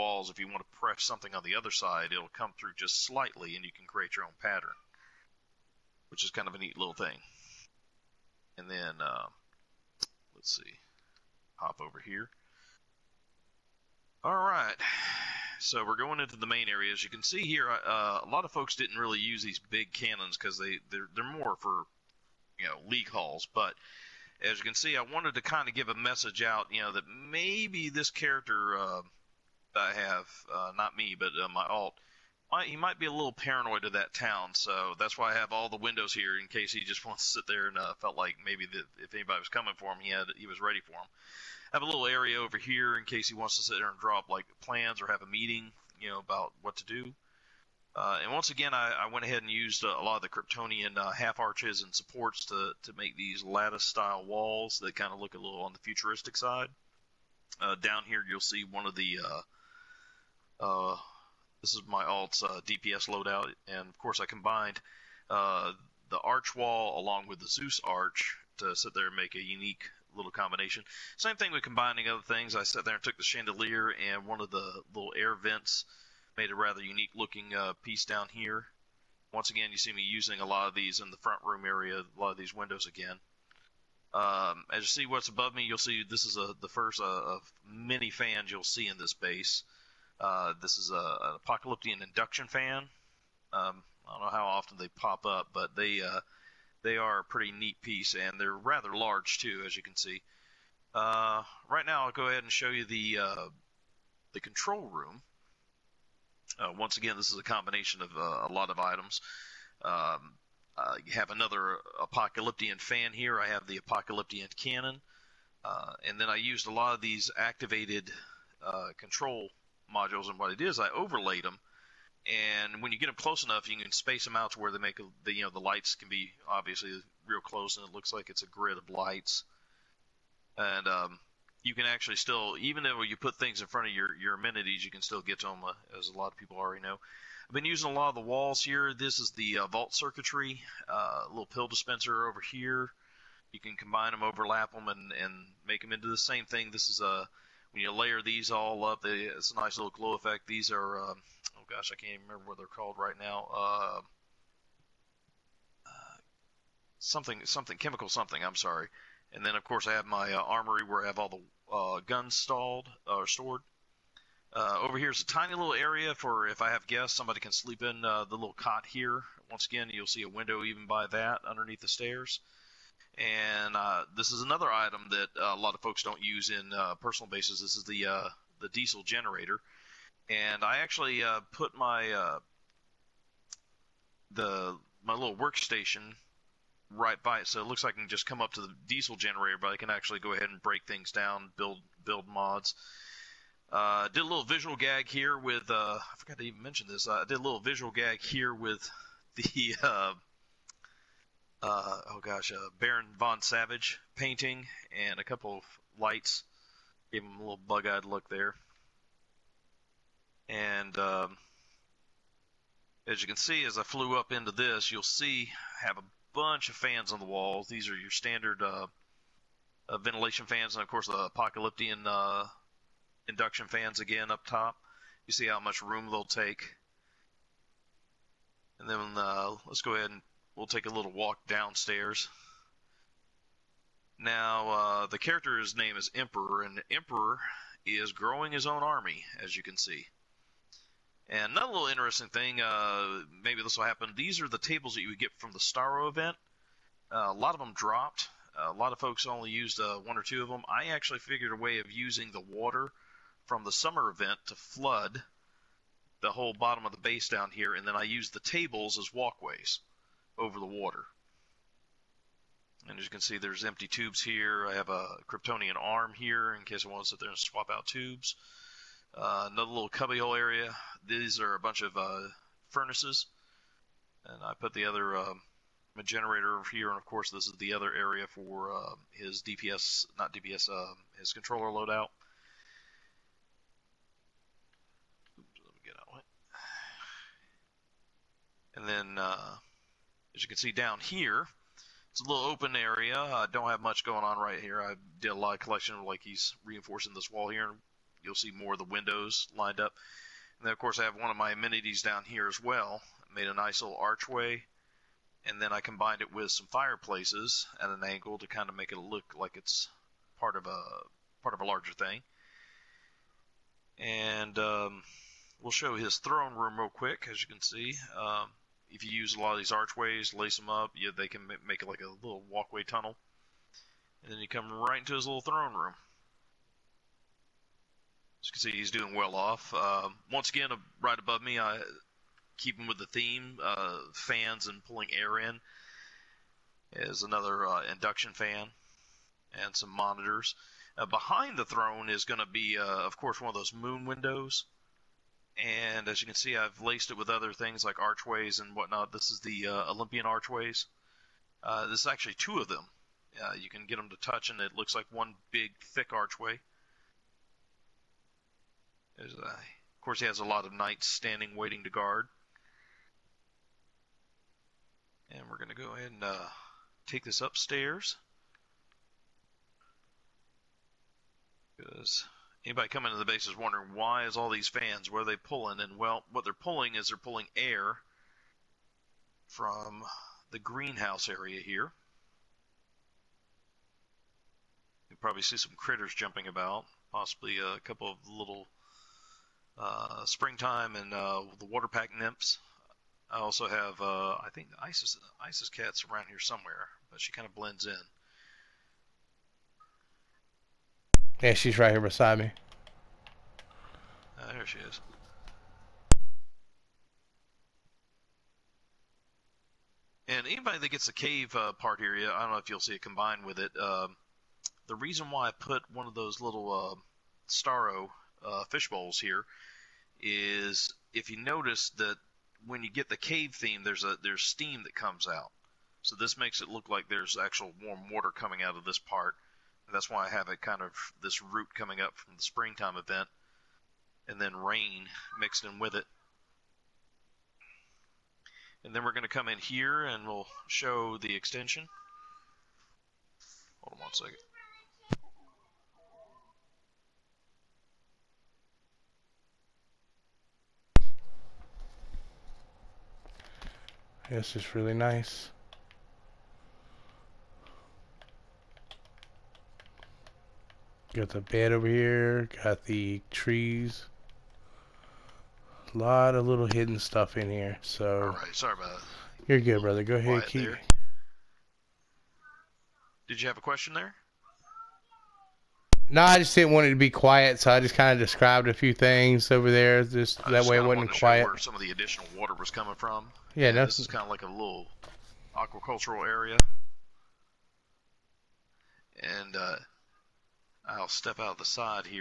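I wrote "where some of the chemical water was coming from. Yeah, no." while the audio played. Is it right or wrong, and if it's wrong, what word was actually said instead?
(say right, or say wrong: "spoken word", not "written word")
wrong: "additional", not "chemical".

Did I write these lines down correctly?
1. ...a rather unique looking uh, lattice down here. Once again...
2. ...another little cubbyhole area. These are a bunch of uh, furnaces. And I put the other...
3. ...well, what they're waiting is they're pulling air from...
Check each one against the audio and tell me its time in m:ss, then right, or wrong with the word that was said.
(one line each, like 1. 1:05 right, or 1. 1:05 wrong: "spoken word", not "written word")
1. 1:16 wrong: "piece", not "lattice"
2. 4:29 right
3. 6:15 wrong: "pulling", not "waiting".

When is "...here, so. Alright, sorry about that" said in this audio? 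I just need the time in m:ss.
7:47.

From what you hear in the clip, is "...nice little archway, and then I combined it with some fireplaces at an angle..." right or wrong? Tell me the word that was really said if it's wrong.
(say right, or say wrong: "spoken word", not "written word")
right.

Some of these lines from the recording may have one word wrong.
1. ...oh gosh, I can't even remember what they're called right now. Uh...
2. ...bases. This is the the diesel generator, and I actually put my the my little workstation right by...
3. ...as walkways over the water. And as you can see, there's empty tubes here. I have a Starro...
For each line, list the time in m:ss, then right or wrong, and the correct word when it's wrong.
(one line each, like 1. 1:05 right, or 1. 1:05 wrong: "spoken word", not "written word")
1. 2:31 right
2. 2:57 right
3. 4:18 wrong: "Kryptonian", not "Starro".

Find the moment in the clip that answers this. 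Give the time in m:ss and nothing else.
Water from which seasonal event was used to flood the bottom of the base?
4:13.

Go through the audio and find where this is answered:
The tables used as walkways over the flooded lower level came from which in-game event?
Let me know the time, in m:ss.
4:05.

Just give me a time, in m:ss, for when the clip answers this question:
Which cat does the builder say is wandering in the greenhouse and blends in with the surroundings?
6:35.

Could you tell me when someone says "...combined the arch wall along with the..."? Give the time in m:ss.
1:04.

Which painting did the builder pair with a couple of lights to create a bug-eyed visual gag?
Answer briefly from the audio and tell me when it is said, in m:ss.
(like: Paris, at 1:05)
Baron von Savage, at 3:22.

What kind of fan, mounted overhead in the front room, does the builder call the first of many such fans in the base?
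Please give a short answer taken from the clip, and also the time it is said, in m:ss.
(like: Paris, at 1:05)
Apocalyptic induction fan, at 1:31.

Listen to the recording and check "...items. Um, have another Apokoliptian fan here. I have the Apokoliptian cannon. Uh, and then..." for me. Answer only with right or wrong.
right.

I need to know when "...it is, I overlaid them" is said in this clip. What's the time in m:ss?
2:00.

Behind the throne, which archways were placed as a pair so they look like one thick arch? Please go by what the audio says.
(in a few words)
Olympian archways.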